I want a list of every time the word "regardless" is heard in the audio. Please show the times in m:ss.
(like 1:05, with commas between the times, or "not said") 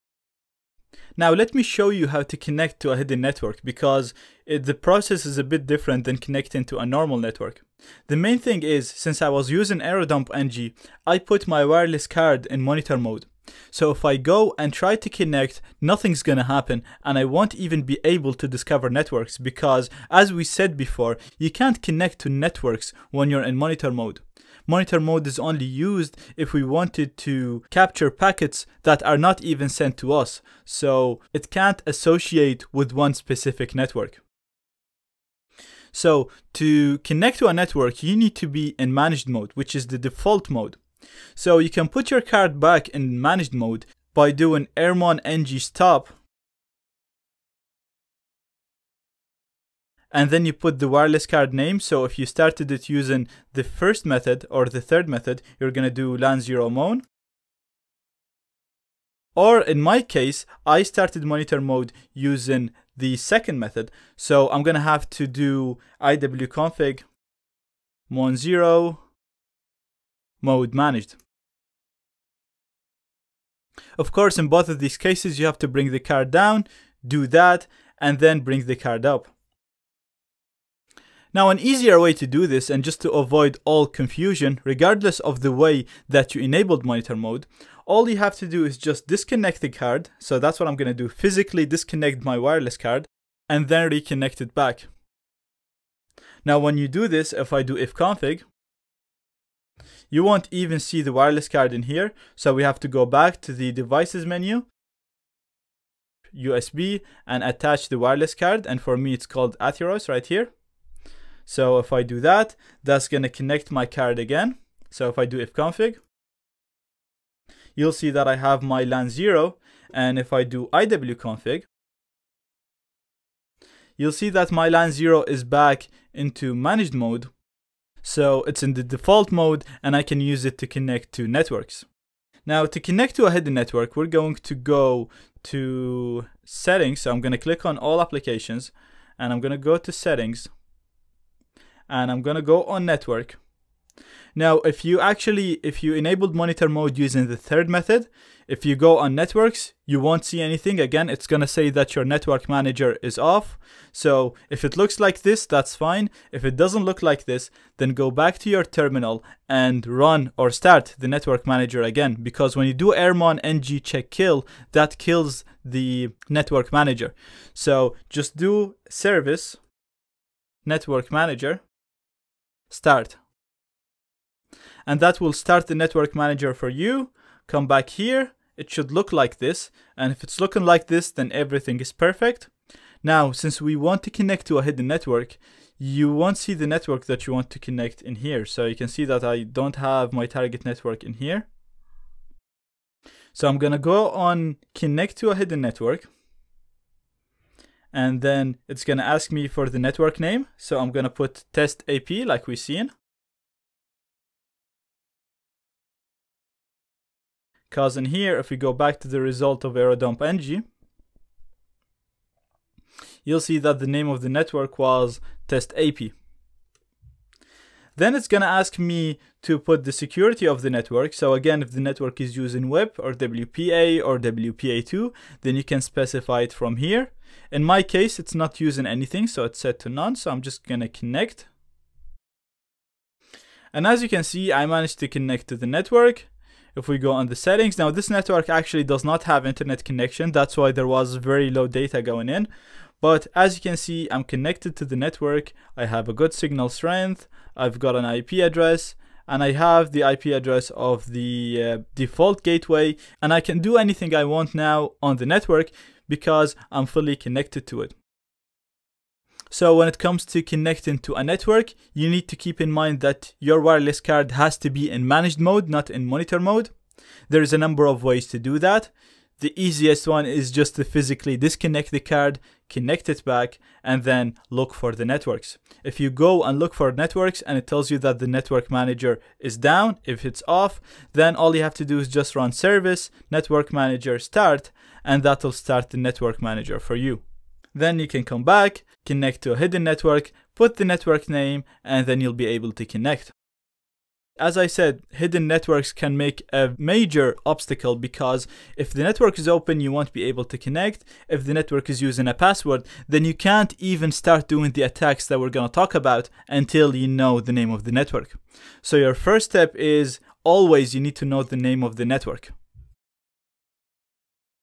1:24.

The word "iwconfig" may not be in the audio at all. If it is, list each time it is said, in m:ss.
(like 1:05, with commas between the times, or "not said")
1:06, 2:00.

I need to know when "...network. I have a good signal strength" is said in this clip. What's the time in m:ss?
4:04.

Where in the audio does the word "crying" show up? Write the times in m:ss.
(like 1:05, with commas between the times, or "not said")
not said.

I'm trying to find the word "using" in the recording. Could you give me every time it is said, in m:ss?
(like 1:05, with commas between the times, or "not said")
0:09, 0:52, 1:02, 2:26, 3:42, 3:48, 5:02.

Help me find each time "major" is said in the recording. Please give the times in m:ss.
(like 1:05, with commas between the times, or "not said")
4:56.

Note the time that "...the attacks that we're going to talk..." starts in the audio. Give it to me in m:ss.
5:04.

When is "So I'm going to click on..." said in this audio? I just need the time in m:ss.
2:17.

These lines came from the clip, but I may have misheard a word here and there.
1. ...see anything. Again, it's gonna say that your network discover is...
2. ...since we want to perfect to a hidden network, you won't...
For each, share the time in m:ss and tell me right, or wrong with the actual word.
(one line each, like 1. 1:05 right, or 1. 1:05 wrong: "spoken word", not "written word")
1. 2:30 wrong: "manager", not "discover"
2. 3:03 wrong: "connect", not "perfect".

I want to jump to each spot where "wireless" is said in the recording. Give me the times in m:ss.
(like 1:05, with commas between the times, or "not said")
0:11, 0:50, 1:32, 1:41, 1:47, 4:23.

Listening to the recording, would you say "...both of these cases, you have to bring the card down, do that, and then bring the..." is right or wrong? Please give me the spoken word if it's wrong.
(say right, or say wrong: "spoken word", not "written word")
right.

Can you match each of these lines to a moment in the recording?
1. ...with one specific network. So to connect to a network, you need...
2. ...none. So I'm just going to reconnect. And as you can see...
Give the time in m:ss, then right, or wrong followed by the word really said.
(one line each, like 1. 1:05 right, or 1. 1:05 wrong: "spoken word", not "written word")
1. 0:32 right
2. 3:49 wrong: "connect", not "reconnect".